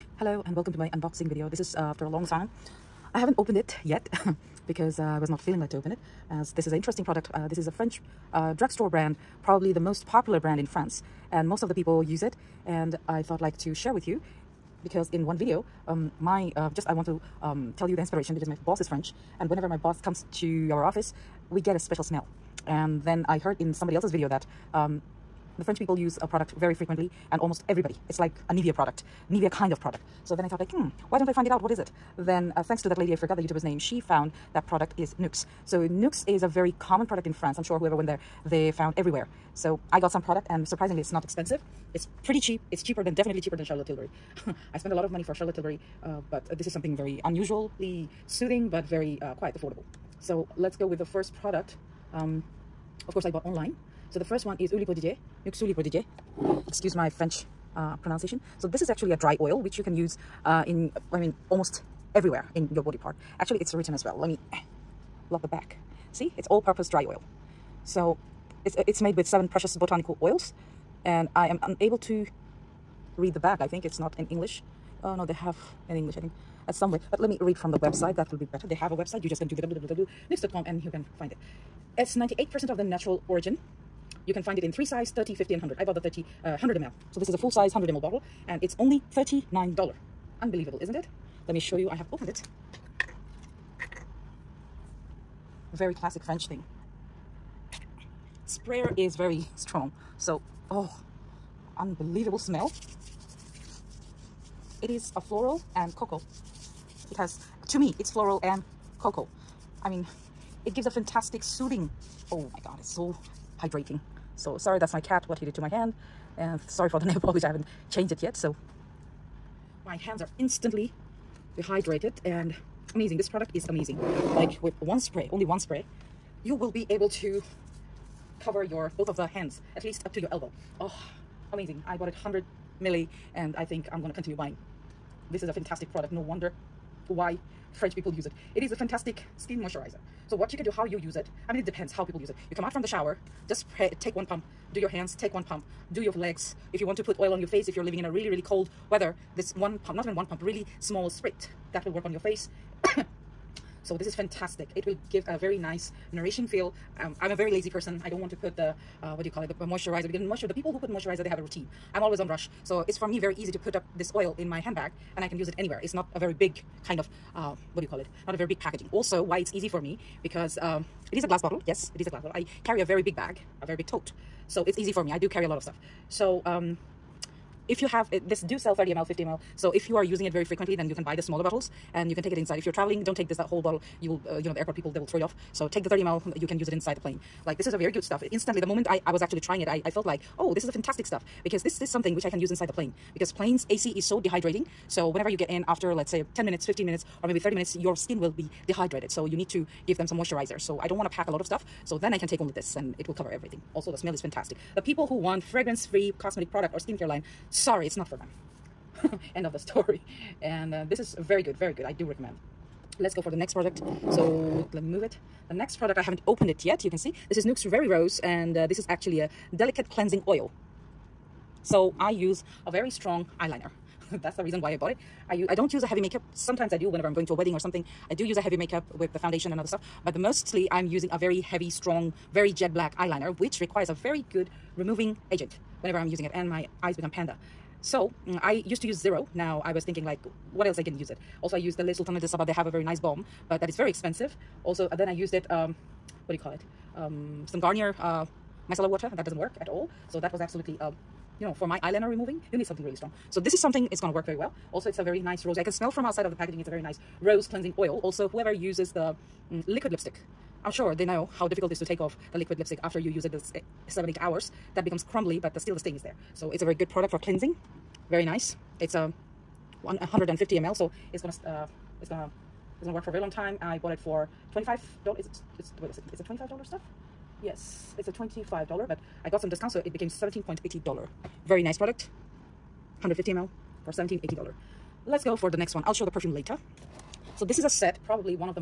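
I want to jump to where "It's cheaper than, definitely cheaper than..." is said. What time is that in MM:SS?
00:42.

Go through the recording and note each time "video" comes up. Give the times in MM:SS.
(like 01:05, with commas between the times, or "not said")
00:01, 00:15, 00:24.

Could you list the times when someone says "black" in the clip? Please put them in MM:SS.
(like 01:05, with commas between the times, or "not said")
03:52.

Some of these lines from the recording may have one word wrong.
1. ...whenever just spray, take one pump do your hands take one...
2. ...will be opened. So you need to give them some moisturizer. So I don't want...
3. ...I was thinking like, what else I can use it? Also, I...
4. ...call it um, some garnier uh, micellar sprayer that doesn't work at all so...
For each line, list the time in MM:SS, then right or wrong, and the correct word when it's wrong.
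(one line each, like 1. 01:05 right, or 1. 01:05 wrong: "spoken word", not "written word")
1. 02:22 wrong: "shower", not "whenever"
2. 03:18 wrong: "dehydrated", not "opened"
3. 03:59 right
4. 04:06 wrong: "water", not "sprayer".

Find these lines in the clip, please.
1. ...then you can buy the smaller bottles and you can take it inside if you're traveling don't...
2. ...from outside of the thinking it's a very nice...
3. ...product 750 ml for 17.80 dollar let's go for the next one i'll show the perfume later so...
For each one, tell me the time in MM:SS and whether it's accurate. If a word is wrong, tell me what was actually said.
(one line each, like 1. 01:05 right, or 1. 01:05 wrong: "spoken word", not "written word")
1. 03:00 right
2. 04:15 wrong: "packaging", not "thinking"
3. 04:41 wrong: "150", not "750".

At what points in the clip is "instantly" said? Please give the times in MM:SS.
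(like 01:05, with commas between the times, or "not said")
02:00, 03:08.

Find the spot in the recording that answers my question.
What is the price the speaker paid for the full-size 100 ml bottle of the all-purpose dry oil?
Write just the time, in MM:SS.
01:29.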